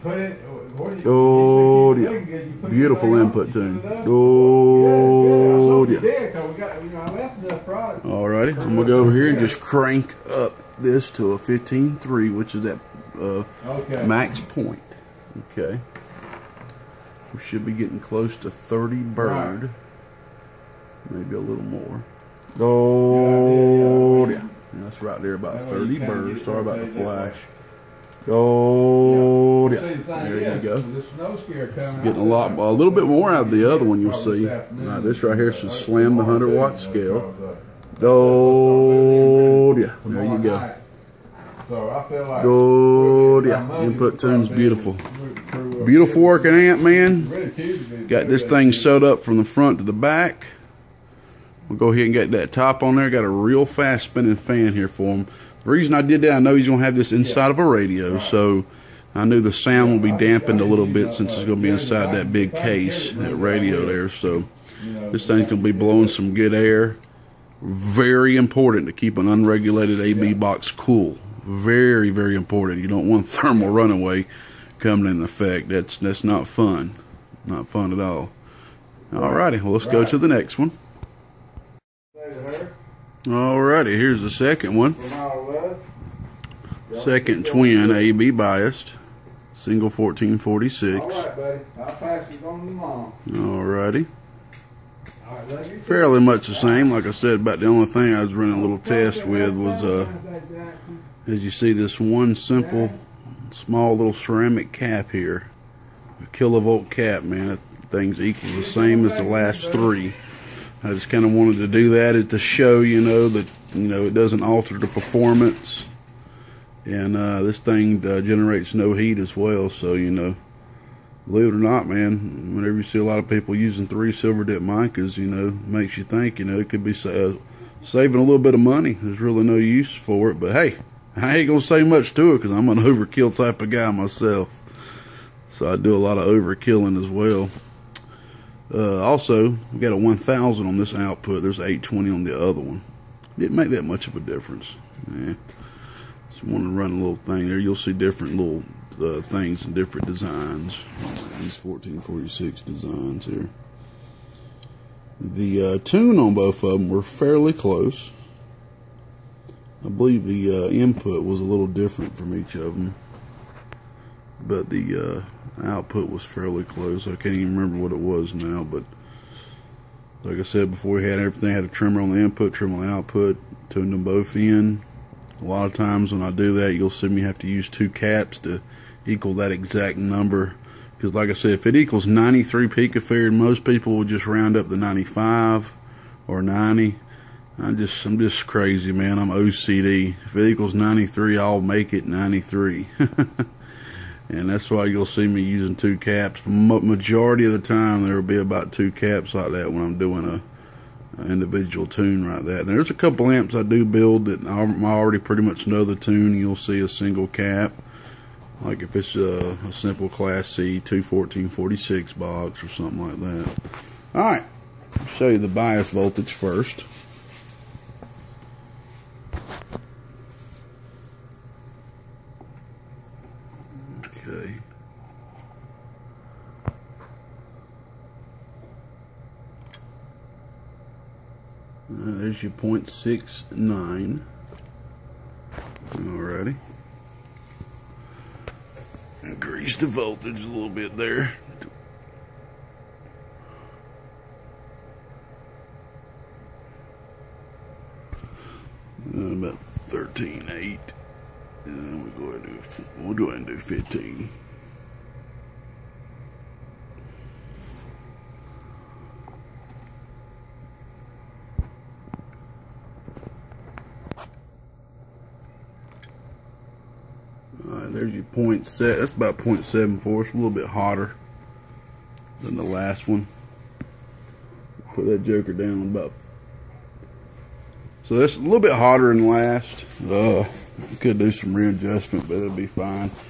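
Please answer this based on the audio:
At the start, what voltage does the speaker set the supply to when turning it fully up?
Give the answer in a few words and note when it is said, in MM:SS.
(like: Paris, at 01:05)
15.3, at 00:11.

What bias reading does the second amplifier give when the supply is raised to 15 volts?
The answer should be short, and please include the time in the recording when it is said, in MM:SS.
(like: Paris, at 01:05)
0.74, at 04:29.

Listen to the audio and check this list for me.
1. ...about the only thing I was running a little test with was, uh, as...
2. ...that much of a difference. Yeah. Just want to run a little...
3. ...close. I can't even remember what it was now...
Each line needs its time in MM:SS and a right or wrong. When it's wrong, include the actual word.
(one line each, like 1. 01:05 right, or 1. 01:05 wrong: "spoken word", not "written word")
1. 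01:37 right
2. 02:23 right
3. 02:46 right.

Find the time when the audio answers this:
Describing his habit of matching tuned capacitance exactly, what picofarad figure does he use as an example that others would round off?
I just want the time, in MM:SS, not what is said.
03:02.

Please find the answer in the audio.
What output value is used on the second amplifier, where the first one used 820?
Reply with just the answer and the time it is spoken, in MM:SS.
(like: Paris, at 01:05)
1000, at 02:19.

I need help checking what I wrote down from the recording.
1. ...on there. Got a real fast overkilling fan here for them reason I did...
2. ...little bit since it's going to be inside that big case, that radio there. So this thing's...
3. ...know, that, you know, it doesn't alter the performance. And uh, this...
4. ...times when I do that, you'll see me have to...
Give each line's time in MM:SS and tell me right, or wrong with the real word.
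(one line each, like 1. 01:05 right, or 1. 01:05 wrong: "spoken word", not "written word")
1. 00:52 wrong: "spinning", not "overkilling"
2. 01:00 right
3. 01:53 right
4. 02:55 right.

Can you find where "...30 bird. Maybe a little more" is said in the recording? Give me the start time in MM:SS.
00:18.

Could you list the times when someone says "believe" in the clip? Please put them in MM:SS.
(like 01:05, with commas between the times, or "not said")
02:01, 02:39.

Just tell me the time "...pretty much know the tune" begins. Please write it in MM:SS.
03:25.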